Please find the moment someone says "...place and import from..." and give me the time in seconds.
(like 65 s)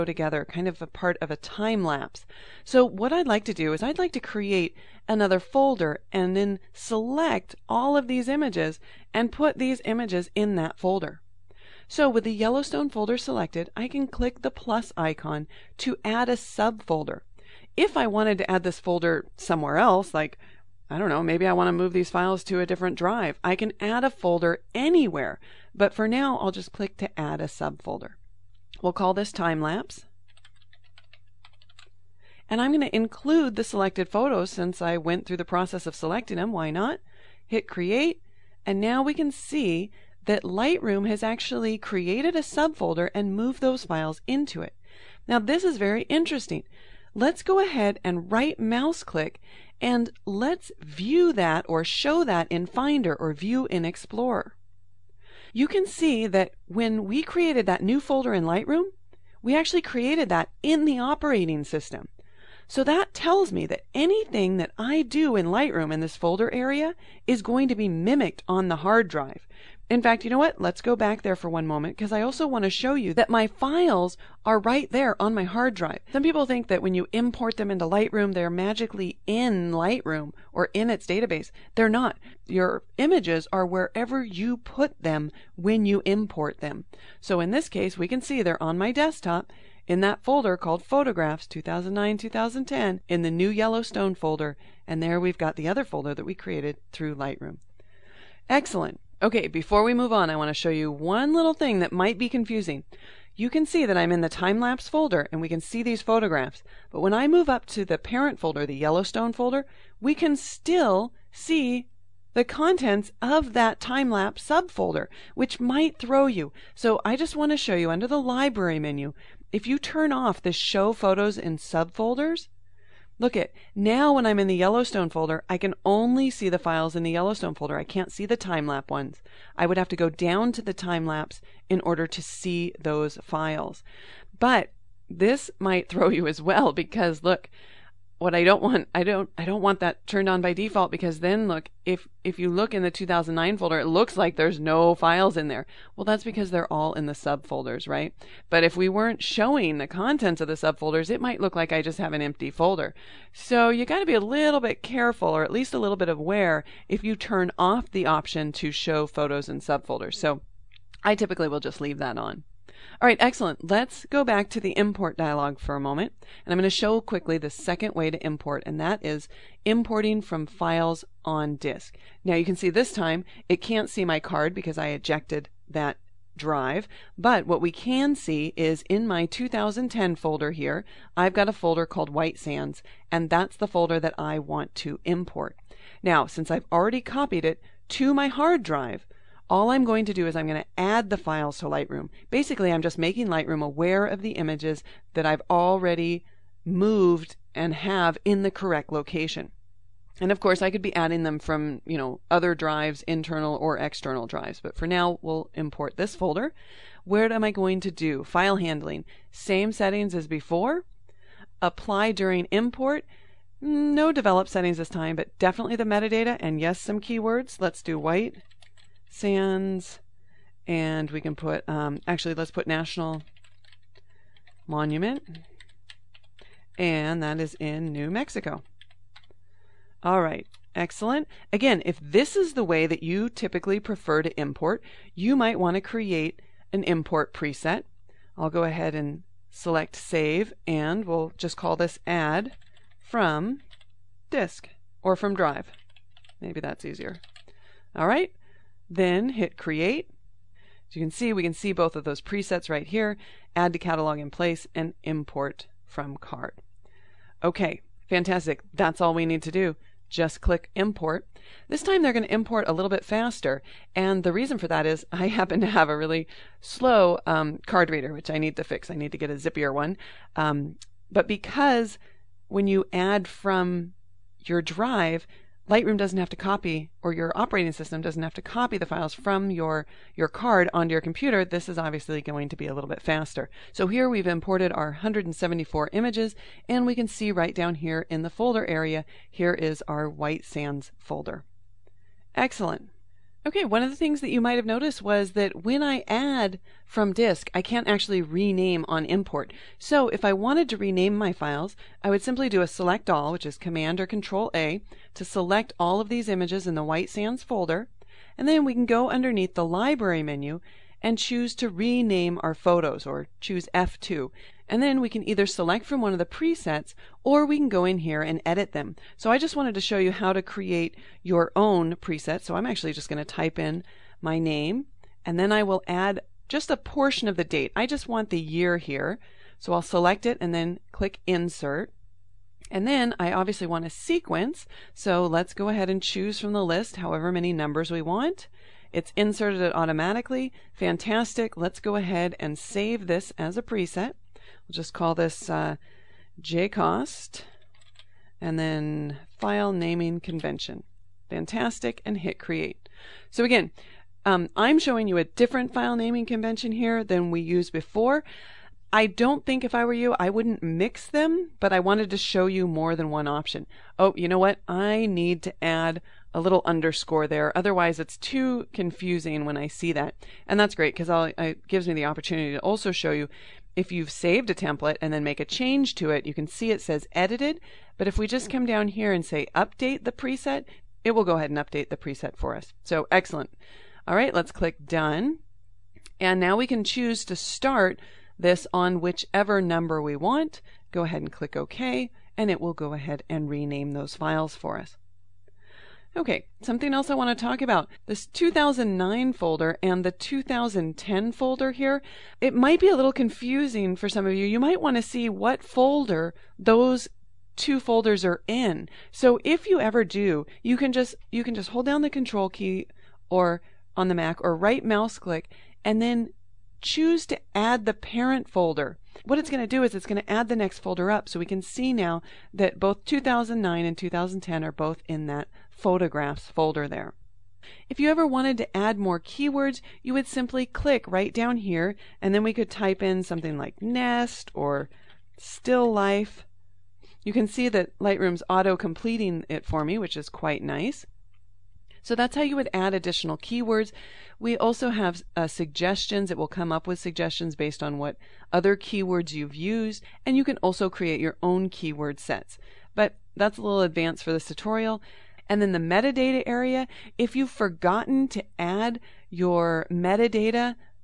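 254 s.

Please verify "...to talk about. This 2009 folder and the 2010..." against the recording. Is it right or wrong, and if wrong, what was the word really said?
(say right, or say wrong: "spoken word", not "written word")
right.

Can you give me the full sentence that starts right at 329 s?
So I'll select it and then click insert.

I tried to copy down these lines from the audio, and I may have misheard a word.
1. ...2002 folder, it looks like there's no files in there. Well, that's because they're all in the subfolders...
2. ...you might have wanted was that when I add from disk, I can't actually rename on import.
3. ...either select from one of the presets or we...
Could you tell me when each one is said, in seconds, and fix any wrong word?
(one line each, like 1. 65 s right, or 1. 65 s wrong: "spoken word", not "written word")
1. 142 s wrong: "2009", not "2002"
2. 294 s wrong: "noticed", not "wanted"
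3. 315 s right.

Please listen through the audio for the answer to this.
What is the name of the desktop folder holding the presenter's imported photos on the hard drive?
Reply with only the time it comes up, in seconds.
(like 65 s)
90 s.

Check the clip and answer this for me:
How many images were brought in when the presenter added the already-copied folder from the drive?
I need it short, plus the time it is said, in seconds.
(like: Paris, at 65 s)
174, at 284 s.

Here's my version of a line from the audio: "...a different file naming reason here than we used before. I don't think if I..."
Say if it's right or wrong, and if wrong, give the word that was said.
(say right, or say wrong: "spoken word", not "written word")
wrong: "convention", not "reason".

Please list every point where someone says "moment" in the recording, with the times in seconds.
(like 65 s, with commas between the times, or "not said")
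71 s, 165 s.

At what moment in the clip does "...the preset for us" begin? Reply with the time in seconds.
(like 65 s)
381 s.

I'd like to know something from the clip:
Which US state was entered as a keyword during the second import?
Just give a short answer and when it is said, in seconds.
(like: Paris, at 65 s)
New Mexico, at 227 s.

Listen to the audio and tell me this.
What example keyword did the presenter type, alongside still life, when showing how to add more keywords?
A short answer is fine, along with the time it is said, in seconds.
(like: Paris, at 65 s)
nest, at 433 s.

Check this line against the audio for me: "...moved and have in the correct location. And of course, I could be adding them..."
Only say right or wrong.
right.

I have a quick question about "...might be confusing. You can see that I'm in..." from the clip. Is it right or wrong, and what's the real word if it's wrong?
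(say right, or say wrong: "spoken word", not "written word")
right.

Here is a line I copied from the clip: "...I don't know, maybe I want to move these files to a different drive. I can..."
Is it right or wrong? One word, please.
right.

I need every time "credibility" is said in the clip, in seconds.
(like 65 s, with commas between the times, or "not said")
not said.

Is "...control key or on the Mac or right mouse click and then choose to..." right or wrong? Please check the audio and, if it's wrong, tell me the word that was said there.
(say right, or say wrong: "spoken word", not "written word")
right.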